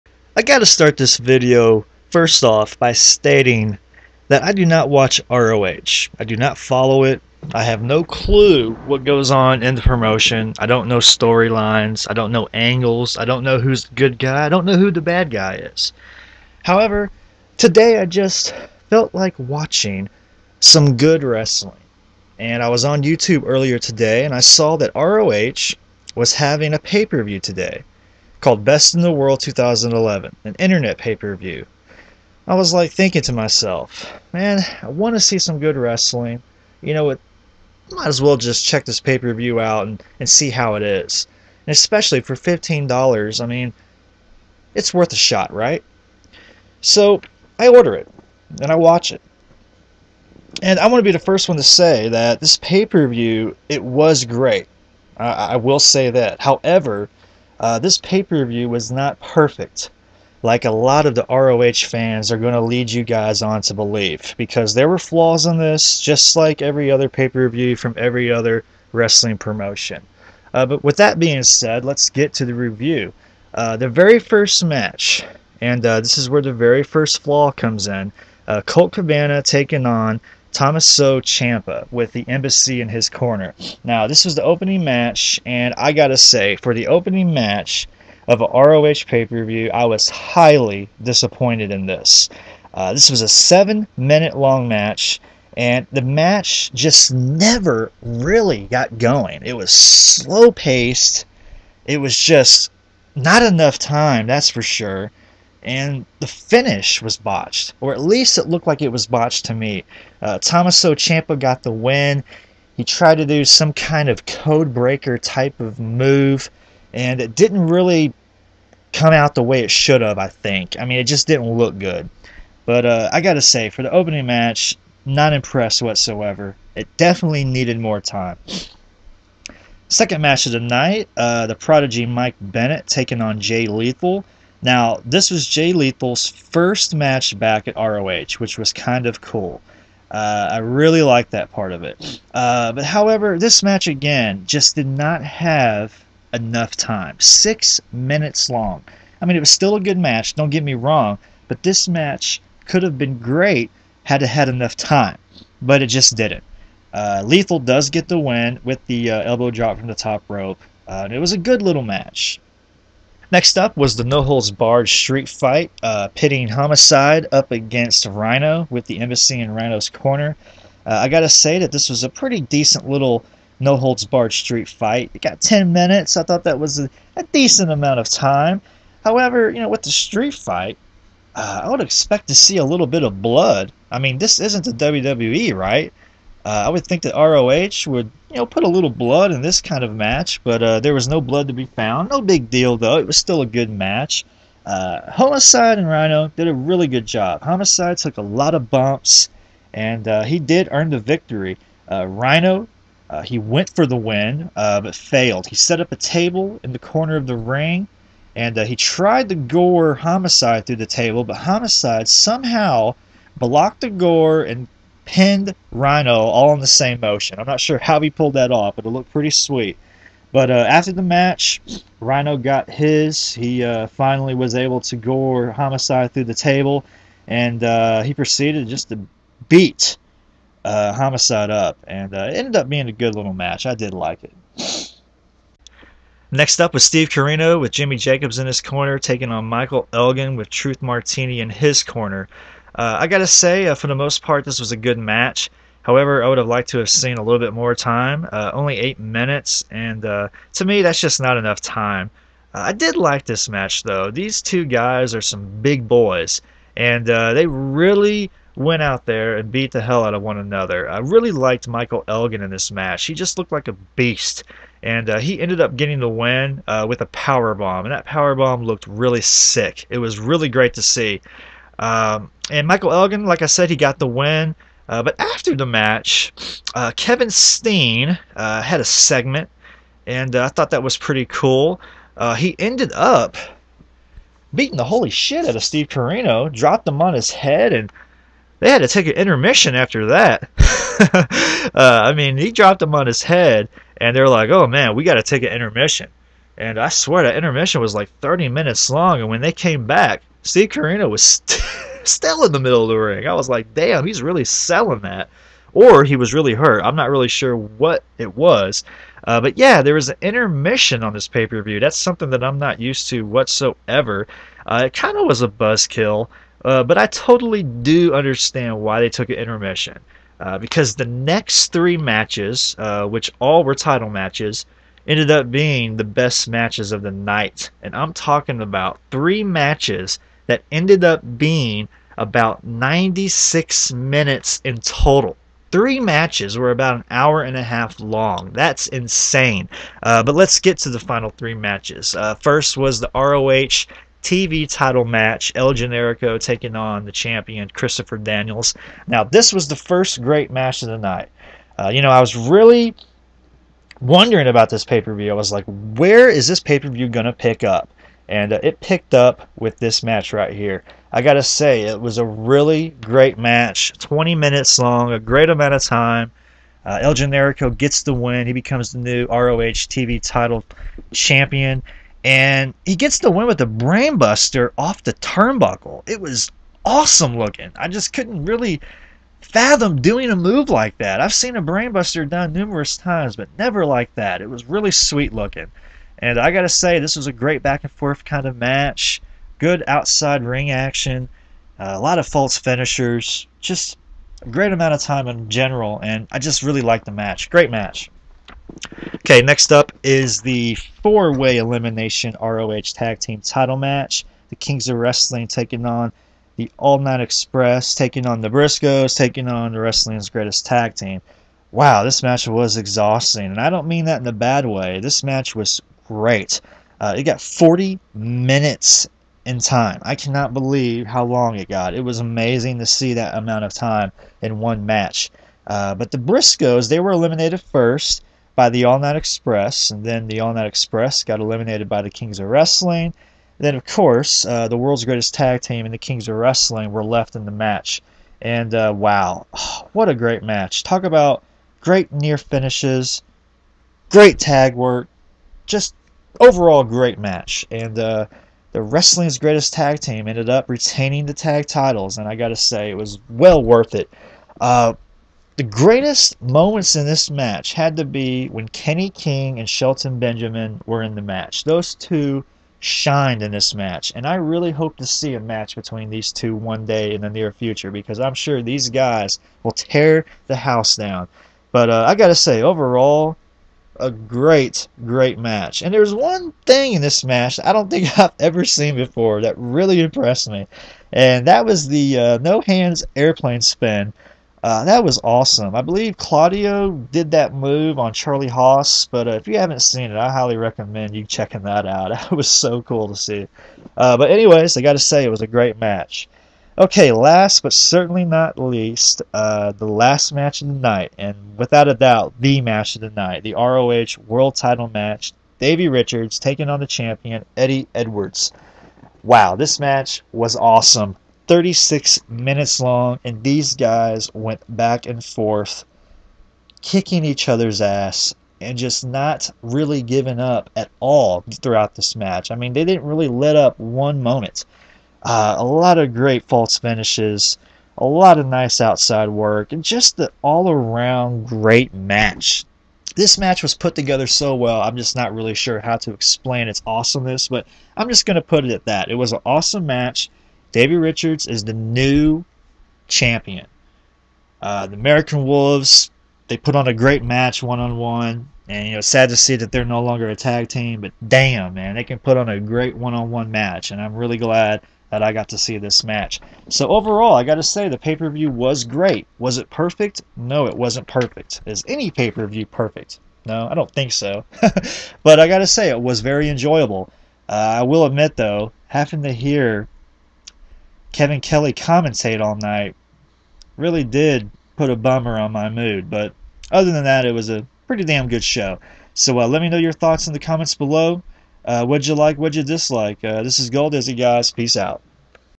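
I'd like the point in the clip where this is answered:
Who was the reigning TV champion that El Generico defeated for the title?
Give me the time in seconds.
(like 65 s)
347 s.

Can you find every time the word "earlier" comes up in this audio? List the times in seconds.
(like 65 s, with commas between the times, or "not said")
23 s.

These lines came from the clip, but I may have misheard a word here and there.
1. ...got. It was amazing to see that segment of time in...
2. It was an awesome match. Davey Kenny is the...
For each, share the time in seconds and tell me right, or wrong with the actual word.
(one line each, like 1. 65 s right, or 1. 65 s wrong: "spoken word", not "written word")
1. 421 s wrong: "amount", not "segment"
2. 539 s wrong: "Richards", not "Kenny".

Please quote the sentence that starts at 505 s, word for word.
Davey Richards taking on the champion Eddie Edwards.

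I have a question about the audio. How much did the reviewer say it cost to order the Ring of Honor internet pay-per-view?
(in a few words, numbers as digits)
$15.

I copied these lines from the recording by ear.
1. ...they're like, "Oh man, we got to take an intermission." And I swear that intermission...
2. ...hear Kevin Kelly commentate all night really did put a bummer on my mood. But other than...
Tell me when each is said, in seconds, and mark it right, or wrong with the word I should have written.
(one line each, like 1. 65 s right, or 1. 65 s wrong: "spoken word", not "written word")
1. 294 s right
2. 569 s right.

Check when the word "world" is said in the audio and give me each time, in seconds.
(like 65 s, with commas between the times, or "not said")
29 s, 434 s, 504 s.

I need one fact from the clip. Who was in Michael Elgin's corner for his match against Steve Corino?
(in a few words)
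Truth Martini.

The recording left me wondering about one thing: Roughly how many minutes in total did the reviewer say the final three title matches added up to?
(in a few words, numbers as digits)
96.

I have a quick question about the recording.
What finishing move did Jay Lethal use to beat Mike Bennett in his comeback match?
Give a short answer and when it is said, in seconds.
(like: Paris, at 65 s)
Elbow drop from the top rope, at 159 s.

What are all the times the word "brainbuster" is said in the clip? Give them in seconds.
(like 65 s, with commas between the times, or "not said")
373 s, 381 s.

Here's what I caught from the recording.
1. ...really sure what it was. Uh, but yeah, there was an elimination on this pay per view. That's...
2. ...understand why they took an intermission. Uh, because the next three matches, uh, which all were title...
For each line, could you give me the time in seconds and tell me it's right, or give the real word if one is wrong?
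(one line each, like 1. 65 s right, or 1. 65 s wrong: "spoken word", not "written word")
1. 307 s wrong: "intermission", not "elimination"
2. 318 s right.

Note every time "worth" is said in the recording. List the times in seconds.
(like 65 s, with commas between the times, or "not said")
44 s, 453 s.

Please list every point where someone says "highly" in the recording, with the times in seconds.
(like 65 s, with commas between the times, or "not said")
90 s, 490 s.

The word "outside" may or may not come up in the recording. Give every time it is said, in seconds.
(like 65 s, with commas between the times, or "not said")
389 s, 528 s.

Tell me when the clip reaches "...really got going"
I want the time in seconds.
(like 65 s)
98 s.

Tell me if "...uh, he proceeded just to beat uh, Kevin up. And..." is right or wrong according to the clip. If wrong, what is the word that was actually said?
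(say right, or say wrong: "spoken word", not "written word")
wrong: "Homicide", not "Kevin".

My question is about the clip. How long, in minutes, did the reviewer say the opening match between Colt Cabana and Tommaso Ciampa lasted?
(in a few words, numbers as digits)
7 minutes.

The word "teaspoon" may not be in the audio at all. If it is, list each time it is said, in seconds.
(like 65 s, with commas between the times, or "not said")
not said.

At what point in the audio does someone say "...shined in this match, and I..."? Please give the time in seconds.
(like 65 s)
462 s.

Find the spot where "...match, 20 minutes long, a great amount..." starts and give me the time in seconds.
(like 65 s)
363 s.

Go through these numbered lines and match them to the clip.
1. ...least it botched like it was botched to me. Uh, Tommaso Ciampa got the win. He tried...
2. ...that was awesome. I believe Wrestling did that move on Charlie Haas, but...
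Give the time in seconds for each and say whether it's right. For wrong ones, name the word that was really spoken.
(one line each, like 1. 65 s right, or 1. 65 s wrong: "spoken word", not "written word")
1. 108 s wrong: "looked", not "botched"
2. 484 s wrong: "Claudio", not "Wrestling".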